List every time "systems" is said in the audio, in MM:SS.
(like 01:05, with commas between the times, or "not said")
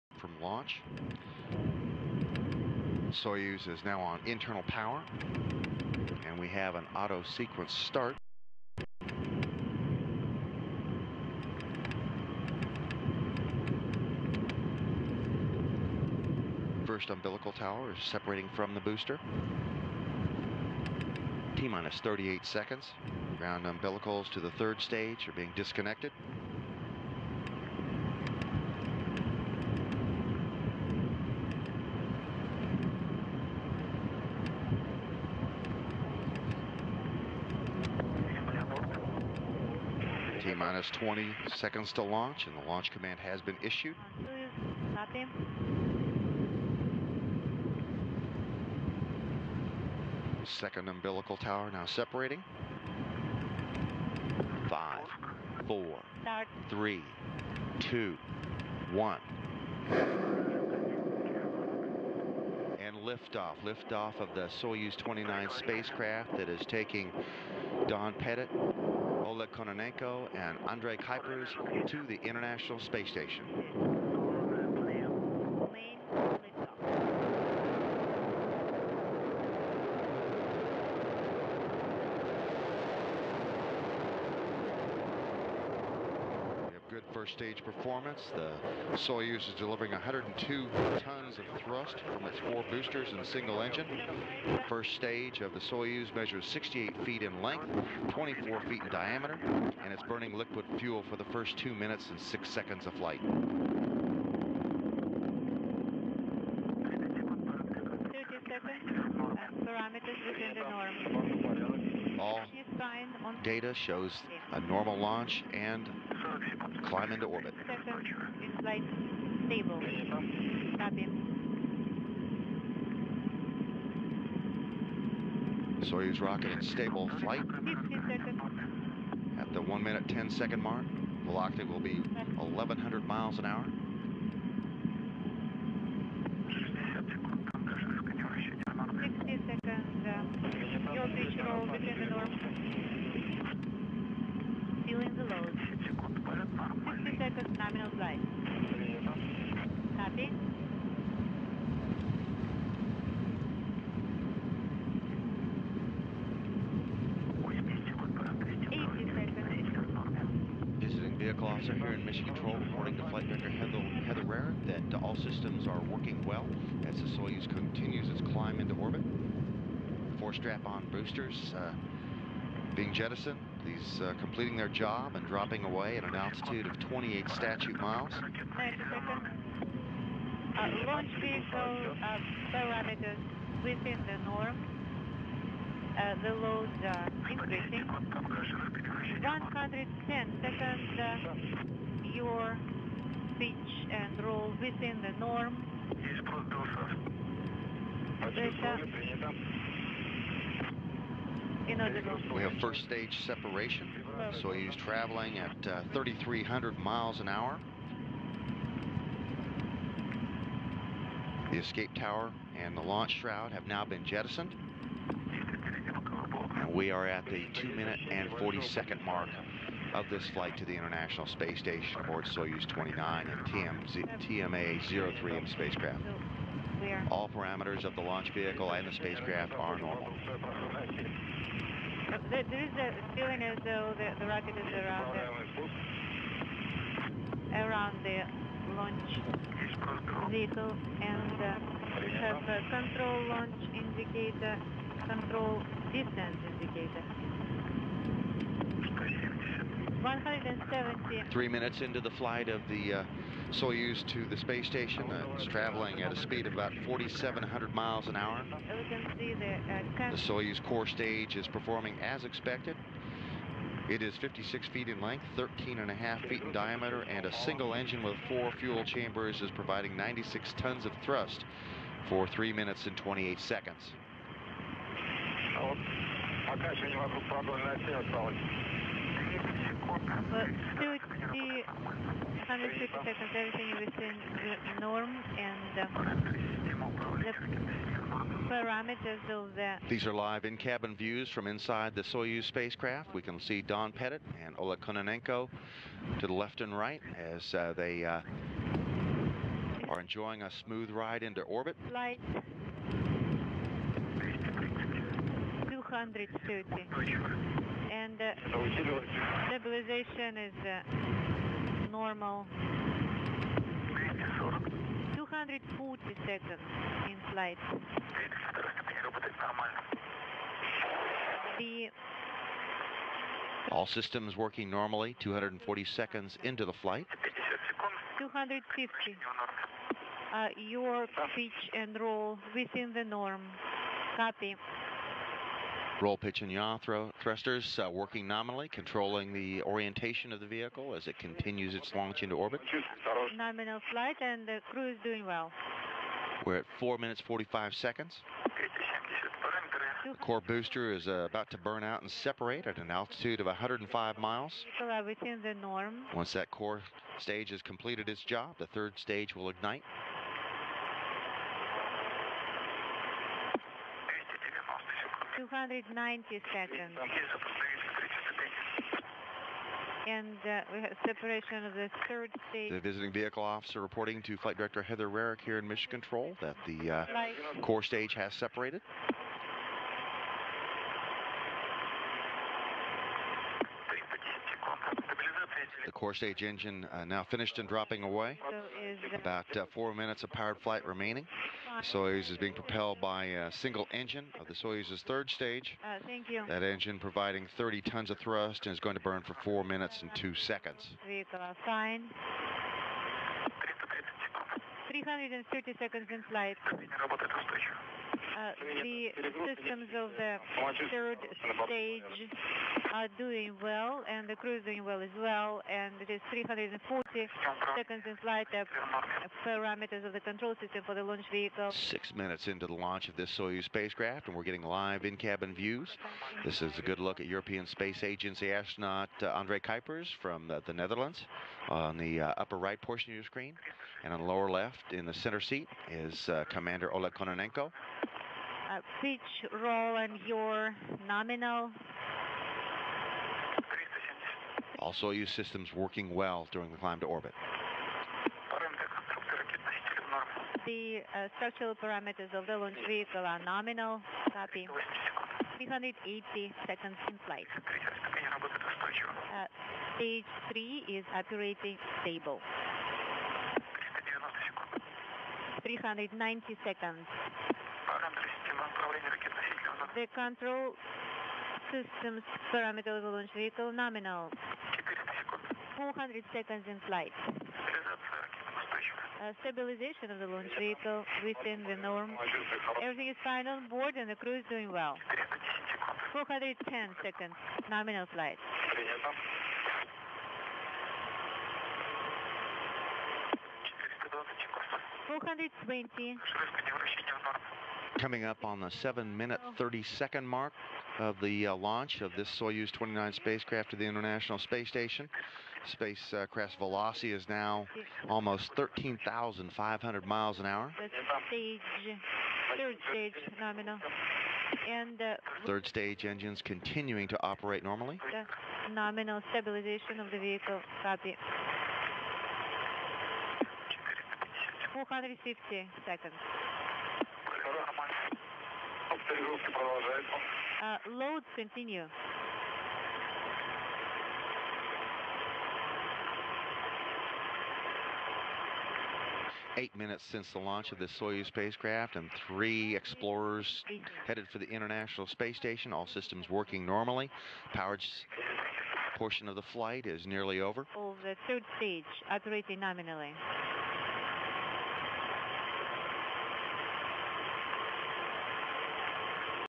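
02:45, 05:23, 06:49, 07:00, 07:25, 07:51, 09:05.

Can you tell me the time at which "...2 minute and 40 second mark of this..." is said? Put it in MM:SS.
03:37.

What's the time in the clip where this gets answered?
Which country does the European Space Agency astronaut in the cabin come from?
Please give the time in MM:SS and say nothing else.
07:10.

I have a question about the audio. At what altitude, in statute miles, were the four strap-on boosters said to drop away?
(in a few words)
28 statute miles.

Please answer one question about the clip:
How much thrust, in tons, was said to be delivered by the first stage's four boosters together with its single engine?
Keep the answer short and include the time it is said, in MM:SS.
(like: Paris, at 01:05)
102 tons, at 01:29.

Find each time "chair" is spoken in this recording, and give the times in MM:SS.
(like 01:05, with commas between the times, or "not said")
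not said.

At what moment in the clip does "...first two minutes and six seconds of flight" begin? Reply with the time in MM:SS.
01:41.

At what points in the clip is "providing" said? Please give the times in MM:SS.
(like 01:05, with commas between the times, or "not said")
04:29, 06:36.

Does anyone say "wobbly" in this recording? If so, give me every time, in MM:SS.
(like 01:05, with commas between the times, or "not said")
not said.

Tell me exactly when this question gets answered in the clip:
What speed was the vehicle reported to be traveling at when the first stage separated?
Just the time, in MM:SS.
03:25.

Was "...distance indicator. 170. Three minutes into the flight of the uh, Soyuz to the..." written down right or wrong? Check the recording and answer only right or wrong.
right.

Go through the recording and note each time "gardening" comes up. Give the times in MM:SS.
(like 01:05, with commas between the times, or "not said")
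not said.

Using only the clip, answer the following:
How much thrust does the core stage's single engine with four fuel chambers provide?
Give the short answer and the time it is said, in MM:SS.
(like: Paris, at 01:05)
96 tons, at 04:29.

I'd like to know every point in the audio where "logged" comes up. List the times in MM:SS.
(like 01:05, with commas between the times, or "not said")
not said.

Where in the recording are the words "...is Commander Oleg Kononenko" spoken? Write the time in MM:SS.
07:15.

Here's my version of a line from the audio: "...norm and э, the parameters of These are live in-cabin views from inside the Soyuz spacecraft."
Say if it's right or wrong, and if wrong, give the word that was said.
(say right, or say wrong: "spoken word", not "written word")
right.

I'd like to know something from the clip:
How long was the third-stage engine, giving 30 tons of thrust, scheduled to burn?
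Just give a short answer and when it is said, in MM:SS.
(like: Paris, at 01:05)
4 minutes 2 seconds, at 06:39.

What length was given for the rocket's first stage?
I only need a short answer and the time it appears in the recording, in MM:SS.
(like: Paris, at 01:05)
68 feet, at 01:36.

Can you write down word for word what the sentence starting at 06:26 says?
stage engine uh, now finished and dropping away.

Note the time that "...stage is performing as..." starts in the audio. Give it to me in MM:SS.
04:20.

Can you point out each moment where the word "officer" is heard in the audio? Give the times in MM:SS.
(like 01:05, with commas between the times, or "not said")
02:41, 06:13.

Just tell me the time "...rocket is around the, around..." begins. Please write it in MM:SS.
03:54.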